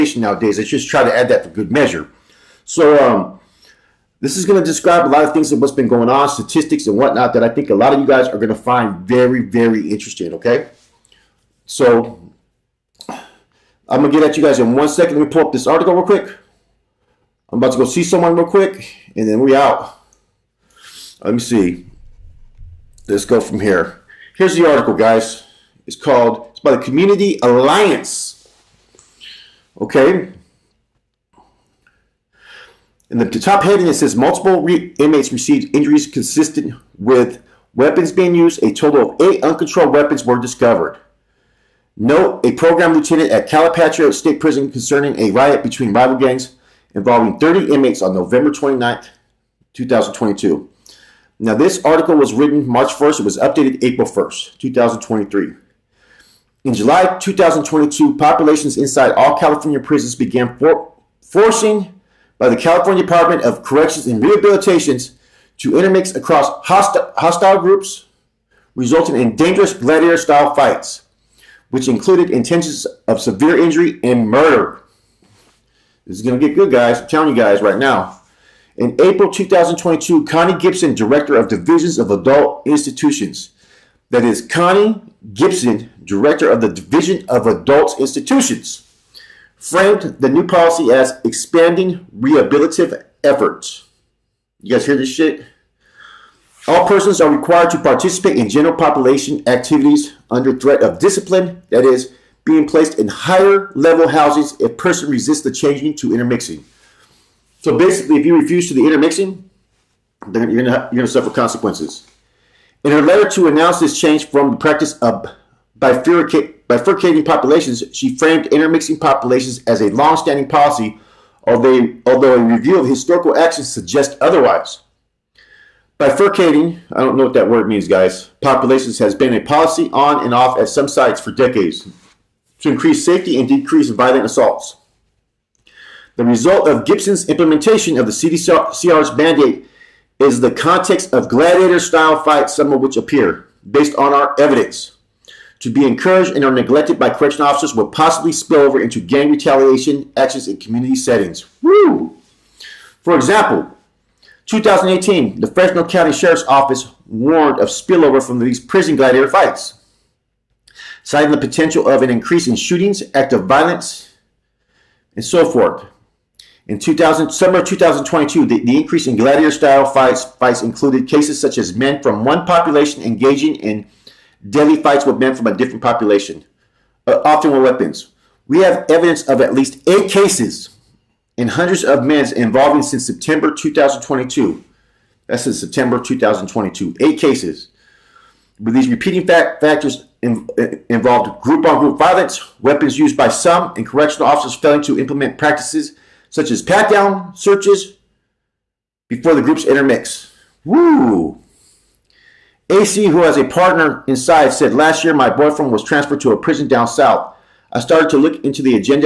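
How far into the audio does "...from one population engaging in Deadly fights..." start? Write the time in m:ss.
2:52.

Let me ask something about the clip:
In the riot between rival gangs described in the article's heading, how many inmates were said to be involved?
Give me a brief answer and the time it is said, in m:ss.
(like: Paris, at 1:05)
30, at 0:47.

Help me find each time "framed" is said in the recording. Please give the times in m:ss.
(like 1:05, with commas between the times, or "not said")
1:29, 1:58.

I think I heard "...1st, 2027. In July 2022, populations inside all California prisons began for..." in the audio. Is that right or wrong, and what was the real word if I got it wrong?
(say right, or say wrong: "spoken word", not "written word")
wrong: "2023", not "2027".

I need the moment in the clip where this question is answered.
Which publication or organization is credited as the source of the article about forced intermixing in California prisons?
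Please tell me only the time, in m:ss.
0:26.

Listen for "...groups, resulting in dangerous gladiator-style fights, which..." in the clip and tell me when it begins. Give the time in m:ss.
1:07.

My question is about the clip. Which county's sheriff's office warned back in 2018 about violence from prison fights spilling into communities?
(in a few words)
Fresno County.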